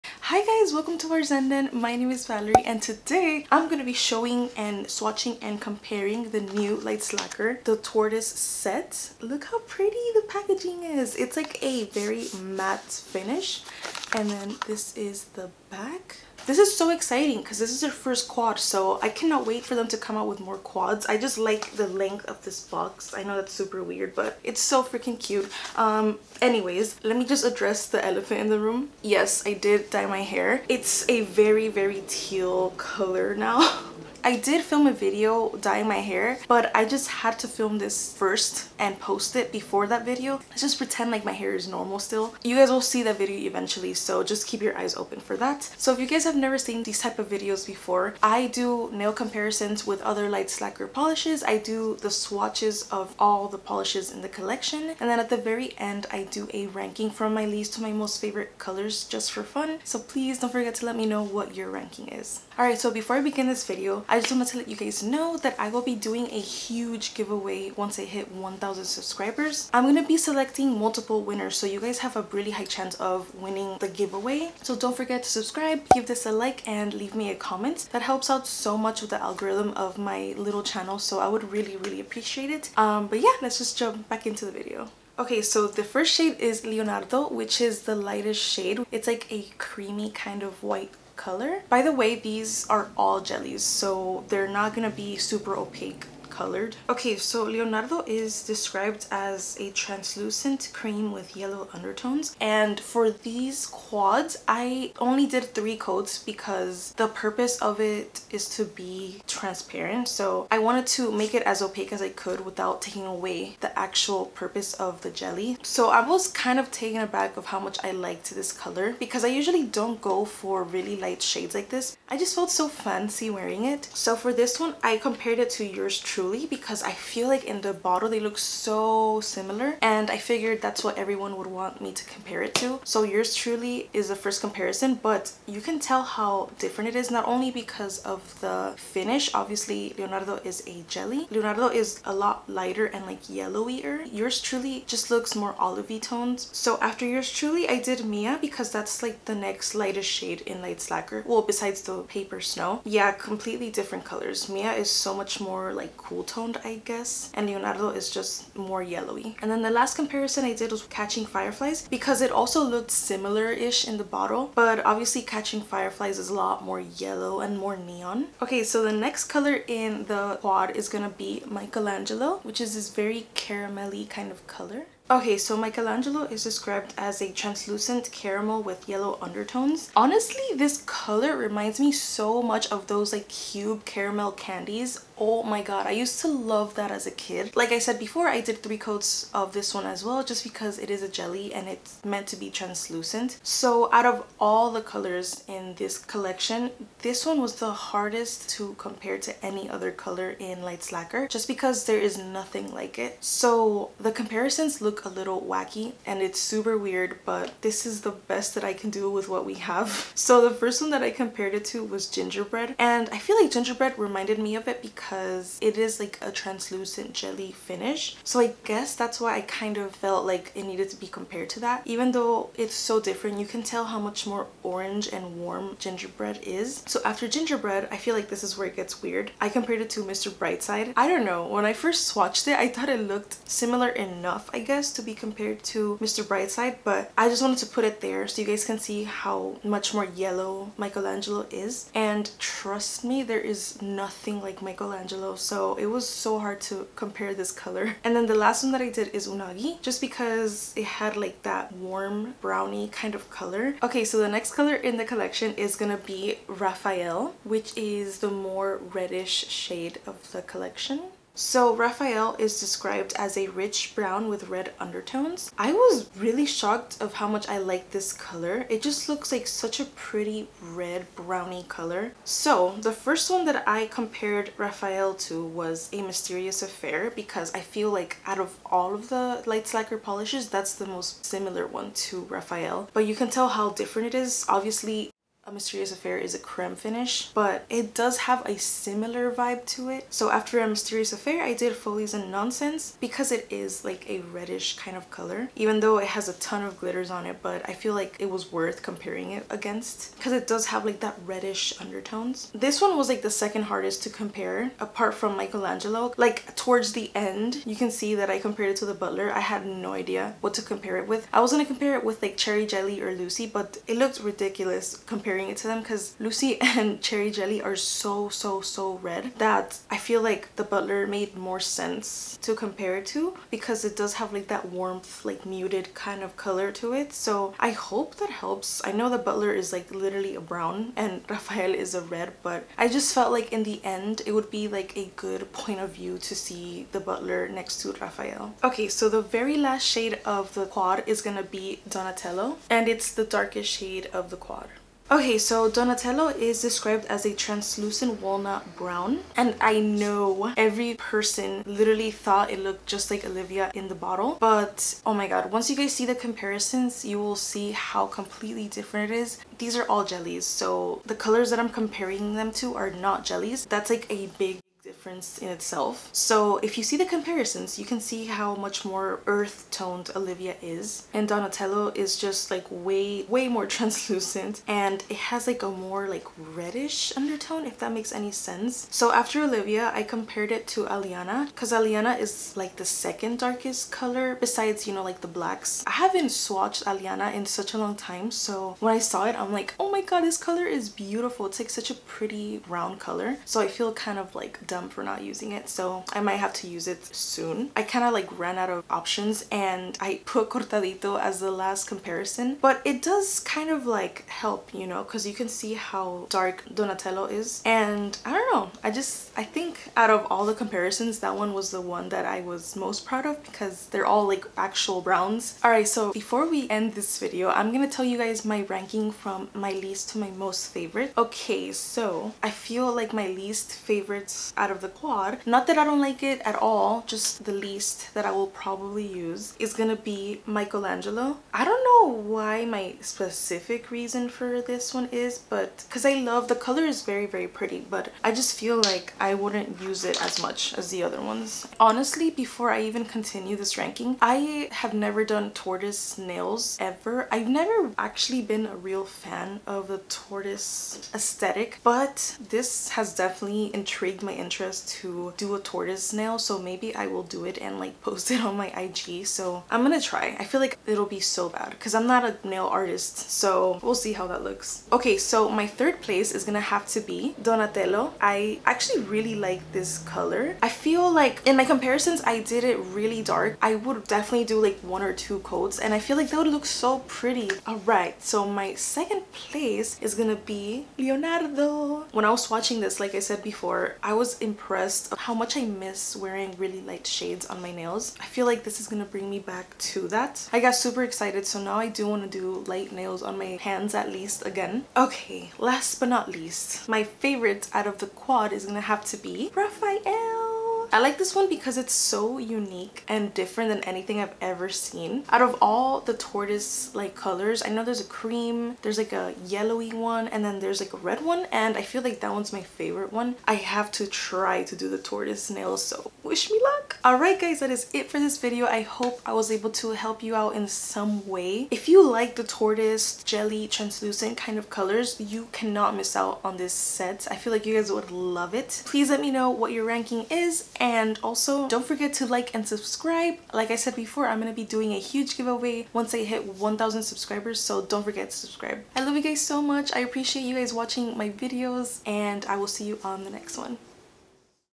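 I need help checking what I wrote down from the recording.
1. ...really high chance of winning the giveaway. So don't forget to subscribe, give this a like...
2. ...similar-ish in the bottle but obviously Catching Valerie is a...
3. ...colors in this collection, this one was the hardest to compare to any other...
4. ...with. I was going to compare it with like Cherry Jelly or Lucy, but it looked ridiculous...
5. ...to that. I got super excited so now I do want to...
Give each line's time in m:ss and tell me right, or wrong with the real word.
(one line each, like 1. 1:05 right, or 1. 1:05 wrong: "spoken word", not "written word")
1. 1:12 right
2. 2:42 wrong: "Fireflies", not "Valerie"
3. 3:14 right
4. 5:11 right
5. 8:09 right.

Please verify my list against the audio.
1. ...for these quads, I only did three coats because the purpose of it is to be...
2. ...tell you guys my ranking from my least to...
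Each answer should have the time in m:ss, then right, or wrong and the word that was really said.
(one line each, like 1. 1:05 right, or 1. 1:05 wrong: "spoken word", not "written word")
1. 1:42 right
2. 6:57 right.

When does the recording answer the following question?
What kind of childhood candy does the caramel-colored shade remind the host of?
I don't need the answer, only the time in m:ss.
3:03.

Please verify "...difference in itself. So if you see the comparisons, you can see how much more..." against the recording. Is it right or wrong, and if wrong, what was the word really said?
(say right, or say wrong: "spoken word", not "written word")
right.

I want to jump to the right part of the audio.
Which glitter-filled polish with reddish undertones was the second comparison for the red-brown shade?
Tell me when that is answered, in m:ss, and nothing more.
4:51.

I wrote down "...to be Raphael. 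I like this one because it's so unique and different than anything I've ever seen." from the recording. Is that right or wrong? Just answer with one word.
right.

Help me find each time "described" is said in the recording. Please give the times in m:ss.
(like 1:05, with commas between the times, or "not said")
1:38, 2:56, 4:22, 5:46.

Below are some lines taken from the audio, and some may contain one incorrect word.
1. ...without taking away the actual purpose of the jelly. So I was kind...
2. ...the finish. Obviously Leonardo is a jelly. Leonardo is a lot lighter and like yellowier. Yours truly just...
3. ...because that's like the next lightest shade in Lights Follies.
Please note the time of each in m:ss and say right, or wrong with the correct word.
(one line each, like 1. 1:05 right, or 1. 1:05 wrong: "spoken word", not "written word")
1. 1:52 right
2. 2:18 right
3. 2:28 wrong: "Lacquer", not "Follies".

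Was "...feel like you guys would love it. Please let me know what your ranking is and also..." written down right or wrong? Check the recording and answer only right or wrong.
right.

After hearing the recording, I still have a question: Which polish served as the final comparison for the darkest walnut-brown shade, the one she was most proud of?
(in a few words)
Cortadito.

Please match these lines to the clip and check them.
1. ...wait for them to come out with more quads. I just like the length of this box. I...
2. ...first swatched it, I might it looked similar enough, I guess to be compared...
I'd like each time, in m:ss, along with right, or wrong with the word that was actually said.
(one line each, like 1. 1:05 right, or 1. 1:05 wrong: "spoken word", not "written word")
1. 0:19 right
2. 3:51 wrong: "thought", not "might".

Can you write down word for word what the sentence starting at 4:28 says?
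It just looks like such a pretty red browny color.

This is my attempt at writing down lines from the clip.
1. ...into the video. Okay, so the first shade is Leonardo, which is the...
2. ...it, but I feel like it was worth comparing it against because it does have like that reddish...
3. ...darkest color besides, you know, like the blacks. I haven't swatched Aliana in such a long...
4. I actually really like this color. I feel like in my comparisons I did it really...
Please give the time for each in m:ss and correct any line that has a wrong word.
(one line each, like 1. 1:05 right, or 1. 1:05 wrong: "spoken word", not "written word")
1. 1:24 right
2. 4:57 right
3. 6:23 right
4. 7:48 right.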